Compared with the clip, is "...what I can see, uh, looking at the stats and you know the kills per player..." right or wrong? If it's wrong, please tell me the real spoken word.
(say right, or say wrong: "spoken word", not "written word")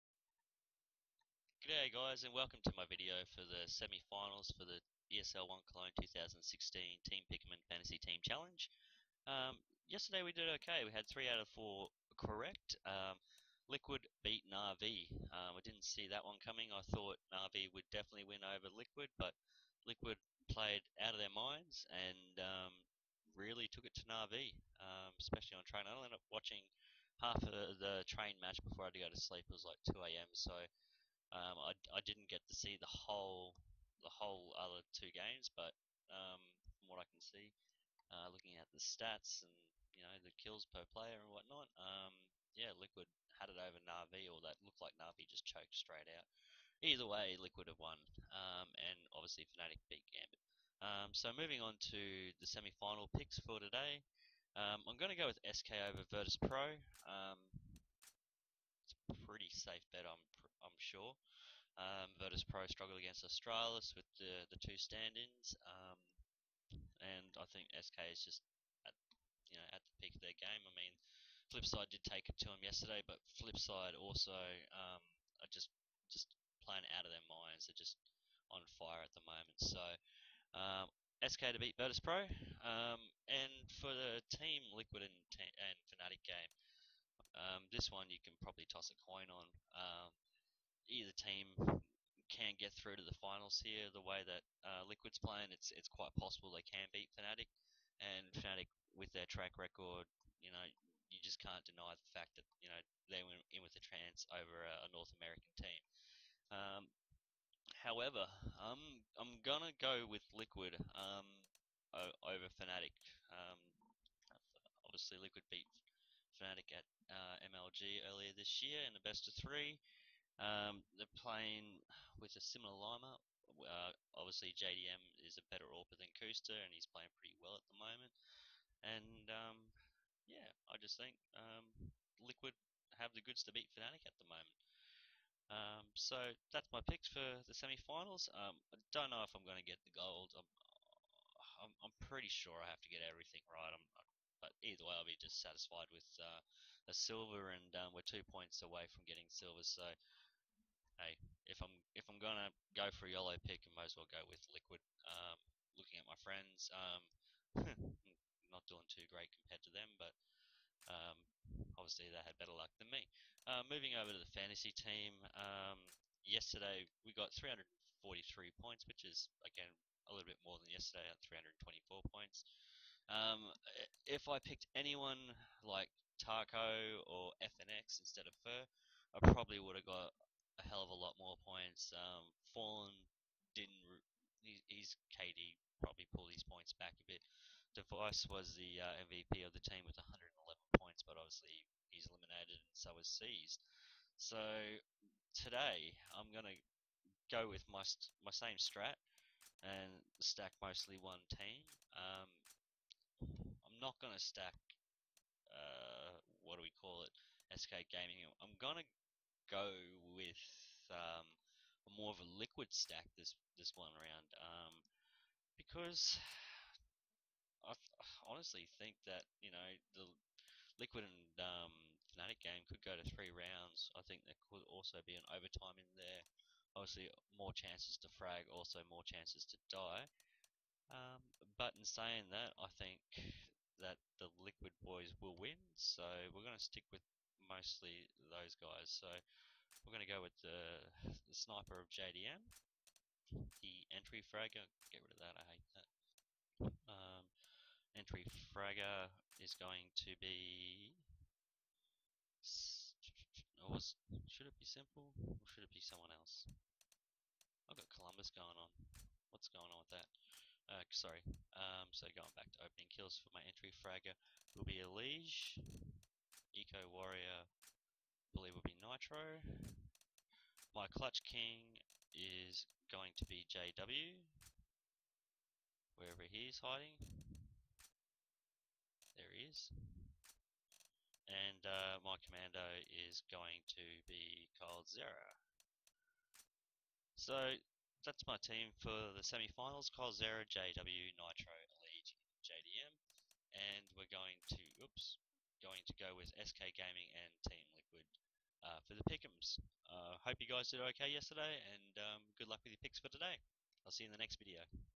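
right.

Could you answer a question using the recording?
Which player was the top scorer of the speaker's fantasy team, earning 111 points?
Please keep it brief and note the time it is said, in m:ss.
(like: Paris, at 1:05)
Device, at 3:07.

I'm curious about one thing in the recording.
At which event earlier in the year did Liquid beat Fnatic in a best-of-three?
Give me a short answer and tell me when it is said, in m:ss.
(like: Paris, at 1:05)
MLG, at 1:57.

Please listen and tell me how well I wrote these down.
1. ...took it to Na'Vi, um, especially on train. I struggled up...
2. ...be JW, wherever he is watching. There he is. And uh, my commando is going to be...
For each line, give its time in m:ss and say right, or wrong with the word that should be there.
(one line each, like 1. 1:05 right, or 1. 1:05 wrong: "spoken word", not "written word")
1. 0:23 wrong: "ended", not "struggled"
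2. 4:33 wrong: "hiding", not "watching".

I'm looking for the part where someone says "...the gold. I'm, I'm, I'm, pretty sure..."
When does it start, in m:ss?
2:19.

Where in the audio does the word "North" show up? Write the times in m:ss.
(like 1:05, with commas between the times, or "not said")
1:44.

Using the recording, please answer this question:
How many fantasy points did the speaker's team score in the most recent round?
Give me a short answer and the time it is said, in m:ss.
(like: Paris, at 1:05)
343, at 2:47.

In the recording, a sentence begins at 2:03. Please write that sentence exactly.
Uh, obviously, JDM is a better AWPer than koosta, and he's playing pretty well at the moment.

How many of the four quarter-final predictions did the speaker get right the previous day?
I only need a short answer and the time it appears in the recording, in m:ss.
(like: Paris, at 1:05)
3, at 0:11.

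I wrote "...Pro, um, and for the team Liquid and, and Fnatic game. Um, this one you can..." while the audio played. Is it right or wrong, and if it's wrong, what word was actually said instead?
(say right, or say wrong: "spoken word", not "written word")
right.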